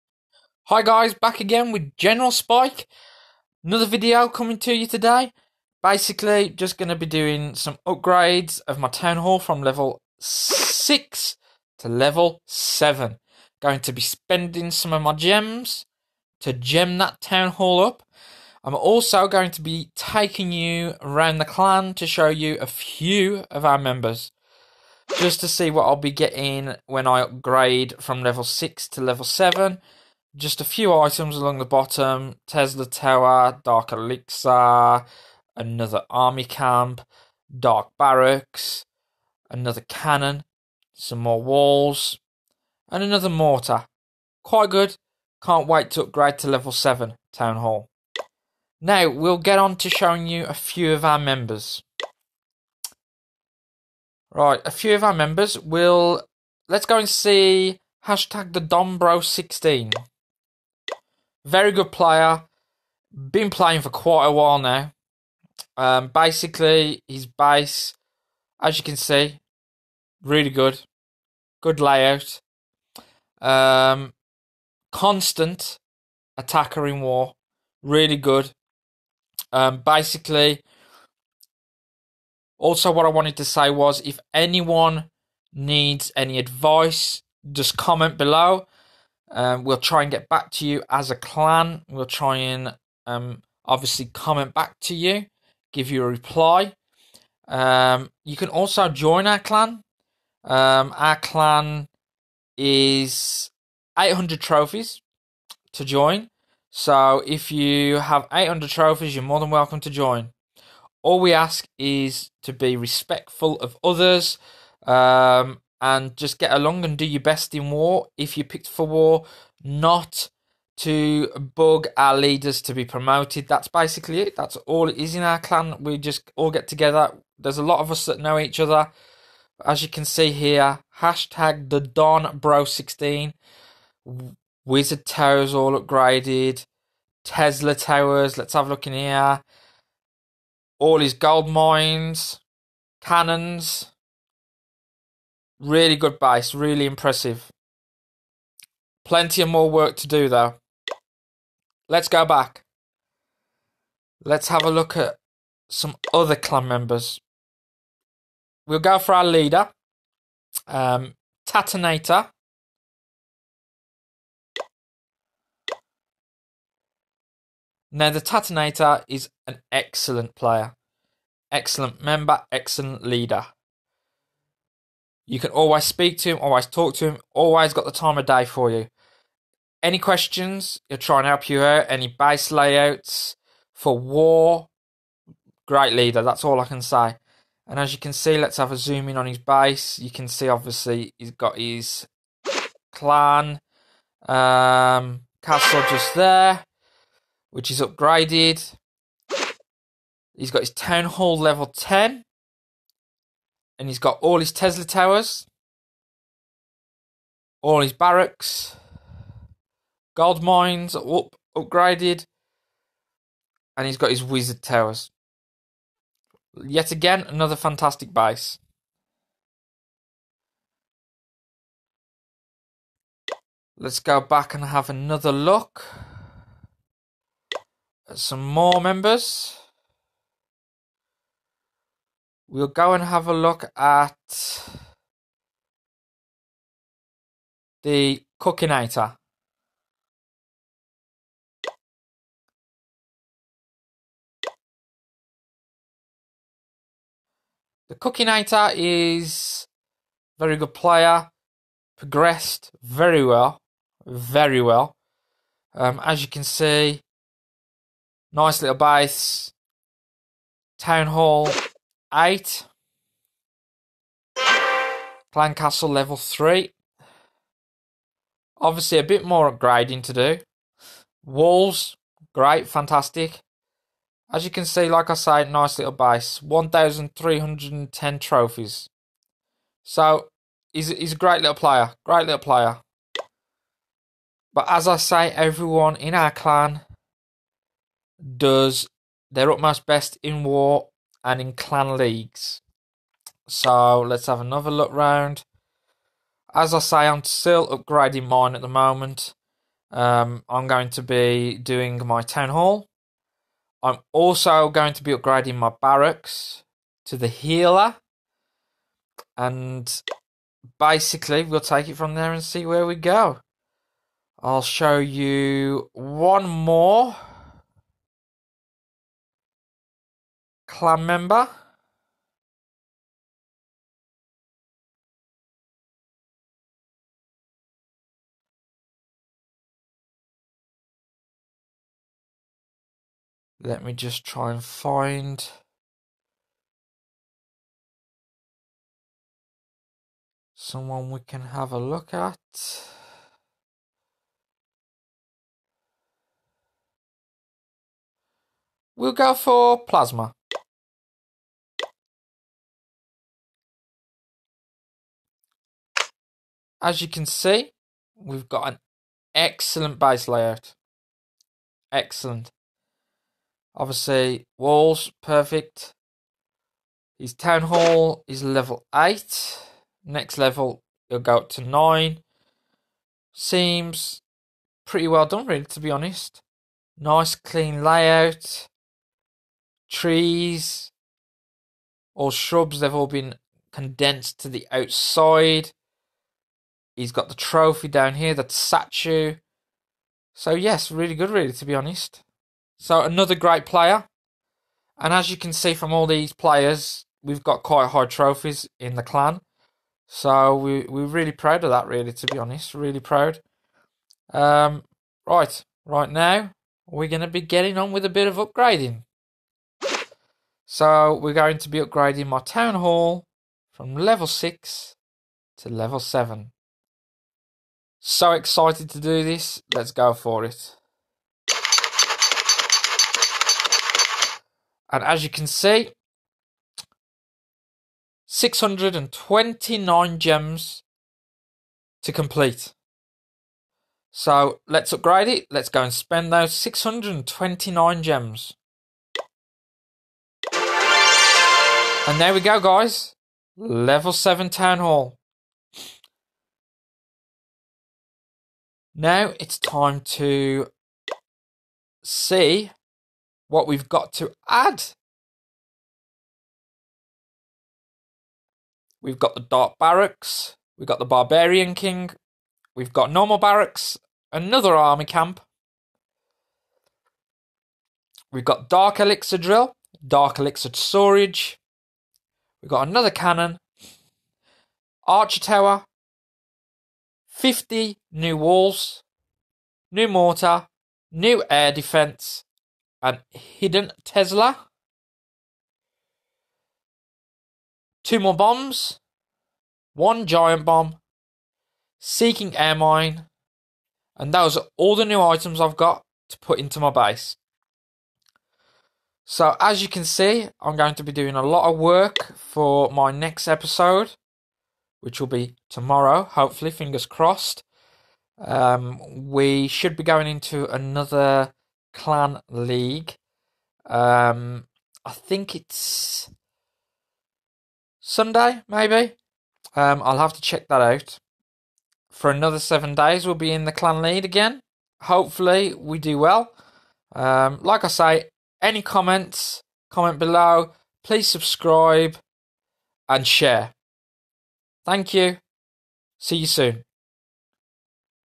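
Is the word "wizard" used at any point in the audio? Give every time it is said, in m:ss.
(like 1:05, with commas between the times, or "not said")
2:14, 3:34.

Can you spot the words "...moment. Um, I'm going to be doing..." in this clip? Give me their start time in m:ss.
4:58.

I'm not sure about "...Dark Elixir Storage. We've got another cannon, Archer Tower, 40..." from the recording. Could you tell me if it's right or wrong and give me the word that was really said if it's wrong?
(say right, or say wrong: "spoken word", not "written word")
wrong: "50", not "40".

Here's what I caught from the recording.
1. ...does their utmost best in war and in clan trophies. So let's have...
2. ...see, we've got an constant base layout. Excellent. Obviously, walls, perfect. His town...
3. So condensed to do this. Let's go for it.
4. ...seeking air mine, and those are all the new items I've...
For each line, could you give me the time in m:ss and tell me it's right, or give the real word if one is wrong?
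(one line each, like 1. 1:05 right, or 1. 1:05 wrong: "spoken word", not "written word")
1. 4:48 wrong: "leagues", not "trophies"
2. 5:57 wrong: "excellent", not "constant"
3. 6:58 wrong: "excited", not "condensed"
4. 8:11 right.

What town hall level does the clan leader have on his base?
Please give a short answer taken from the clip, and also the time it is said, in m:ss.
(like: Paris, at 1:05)
10, at 3:20.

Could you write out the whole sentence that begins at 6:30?
So yes, really good, really, to be honest.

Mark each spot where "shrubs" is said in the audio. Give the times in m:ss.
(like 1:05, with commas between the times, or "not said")
6:22.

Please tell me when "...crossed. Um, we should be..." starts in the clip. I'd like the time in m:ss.
8:27.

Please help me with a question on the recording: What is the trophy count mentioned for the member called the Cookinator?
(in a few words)
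1,310.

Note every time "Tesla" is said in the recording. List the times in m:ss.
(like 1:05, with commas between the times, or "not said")
0:32, 2:17, 3:24, 8:04.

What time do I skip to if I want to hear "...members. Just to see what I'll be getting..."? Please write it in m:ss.
0:23.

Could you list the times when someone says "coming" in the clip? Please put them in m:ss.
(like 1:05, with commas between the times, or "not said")
0:04.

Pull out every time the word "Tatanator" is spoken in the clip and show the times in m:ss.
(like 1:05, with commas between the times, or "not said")
2:41, 2:48.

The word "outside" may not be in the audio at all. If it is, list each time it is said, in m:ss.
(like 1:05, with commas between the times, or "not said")
6:24.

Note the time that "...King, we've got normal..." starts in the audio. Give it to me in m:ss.
7:41.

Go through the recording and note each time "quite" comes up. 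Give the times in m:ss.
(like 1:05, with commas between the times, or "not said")
0:44, 1:03, 6:37.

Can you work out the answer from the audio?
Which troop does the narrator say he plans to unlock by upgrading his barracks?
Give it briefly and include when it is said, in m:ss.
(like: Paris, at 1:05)
Healer, at 5:07.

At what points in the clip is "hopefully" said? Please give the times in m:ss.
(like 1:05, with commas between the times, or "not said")
8:26, 8:45.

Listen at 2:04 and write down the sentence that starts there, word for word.
That's all it is in our clan.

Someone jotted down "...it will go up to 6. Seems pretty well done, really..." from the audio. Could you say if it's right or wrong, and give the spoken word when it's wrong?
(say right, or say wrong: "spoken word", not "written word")
wrong: "9", not "6".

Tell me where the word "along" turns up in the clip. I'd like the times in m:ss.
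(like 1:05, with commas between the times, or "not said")
0:31, 1:56.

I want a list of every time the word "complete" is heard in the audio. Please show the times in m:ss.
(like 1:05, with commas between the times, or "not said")
7:12.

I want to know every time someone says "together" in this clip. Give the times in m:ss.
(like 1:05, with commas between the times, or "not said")
2:06.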